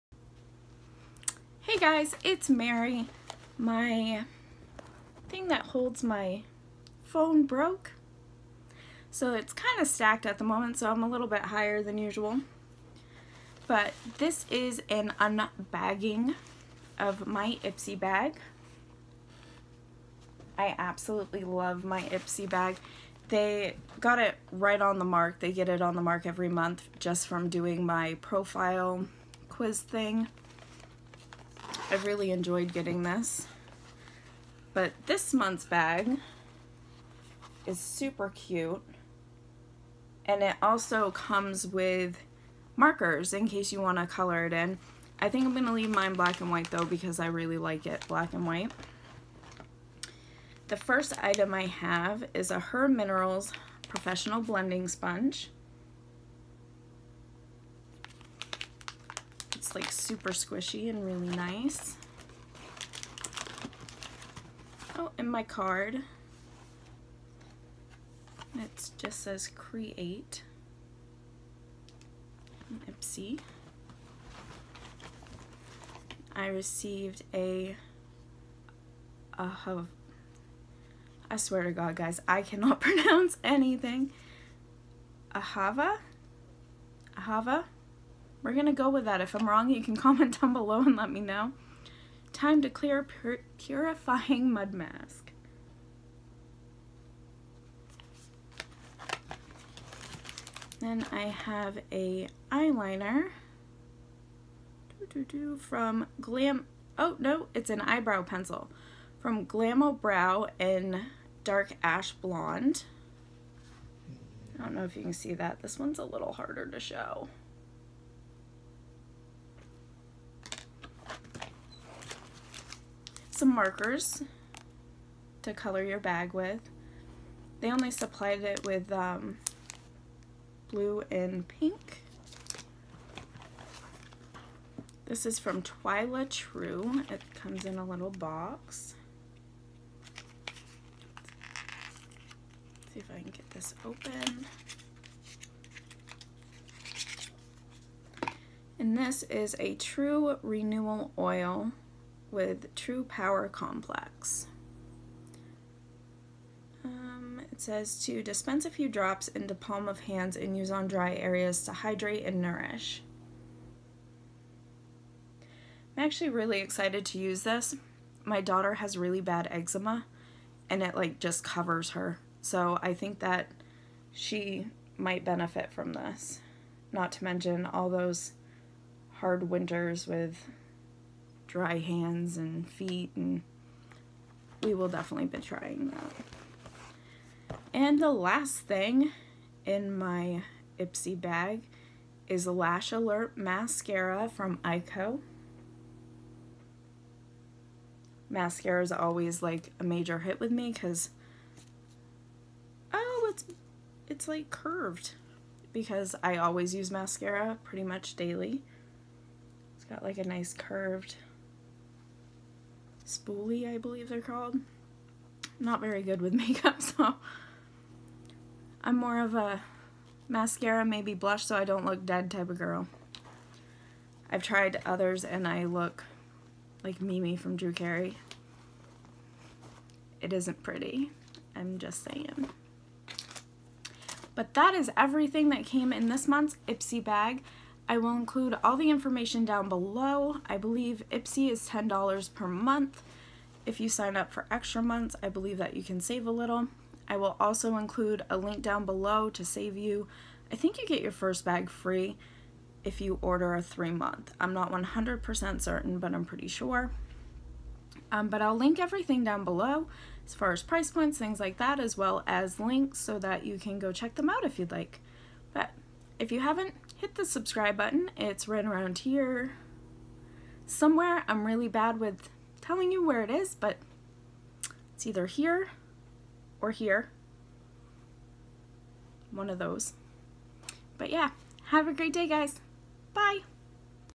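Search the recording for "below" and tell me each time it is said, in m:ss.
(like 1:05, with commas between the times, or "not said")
1:30, 3:59, 4:08, 4:19.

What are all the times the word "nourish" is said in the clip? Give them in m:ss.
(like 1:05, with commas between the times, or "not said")
2:42.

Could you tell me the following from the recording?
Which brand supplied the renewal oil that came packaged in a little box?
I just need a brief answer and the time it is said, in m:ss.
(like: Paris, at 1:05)
Twyla True, at 2:15.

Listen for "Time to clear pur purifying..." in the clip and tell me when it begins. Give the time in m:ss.
1:32.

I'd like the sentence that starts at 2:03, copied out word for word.
some markers to color your bag with.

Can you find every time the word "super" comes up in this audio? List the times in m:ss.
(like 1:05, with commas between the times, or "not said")
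0:37, 0:59.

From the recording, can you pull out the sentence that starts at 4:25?
But if you haven't, hit the subscribe button.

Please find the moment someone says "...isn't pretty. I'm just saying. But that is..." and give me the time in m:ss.
3:50.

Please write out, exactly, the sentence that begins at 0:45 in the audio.
I think I'm going to leave mine black and white though because I really like it black and white.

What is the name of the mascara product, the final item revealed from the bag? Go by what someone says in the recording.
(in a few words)
Lash Alert.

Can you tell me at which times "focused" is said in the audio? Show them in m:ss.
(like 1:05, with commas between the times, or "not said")
not said.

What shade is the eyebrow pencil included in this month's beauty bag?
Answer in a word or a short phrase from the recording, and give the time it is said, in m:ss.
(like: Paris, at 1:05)
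Dark Ash Blonde, at 1:51.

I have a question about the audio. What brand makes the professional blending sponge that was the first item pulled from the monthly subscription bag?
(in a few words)
Her Minerals.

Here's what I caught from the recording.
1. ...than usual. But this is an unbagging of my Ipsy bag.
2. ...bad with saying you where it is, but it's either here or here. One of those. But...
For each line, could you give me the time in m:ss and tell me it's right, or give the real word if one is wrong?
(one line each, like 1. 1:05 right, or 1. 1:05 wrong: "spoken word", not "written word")
1. 0:11 right
2. 4:31 wrong: "telling", not "saying".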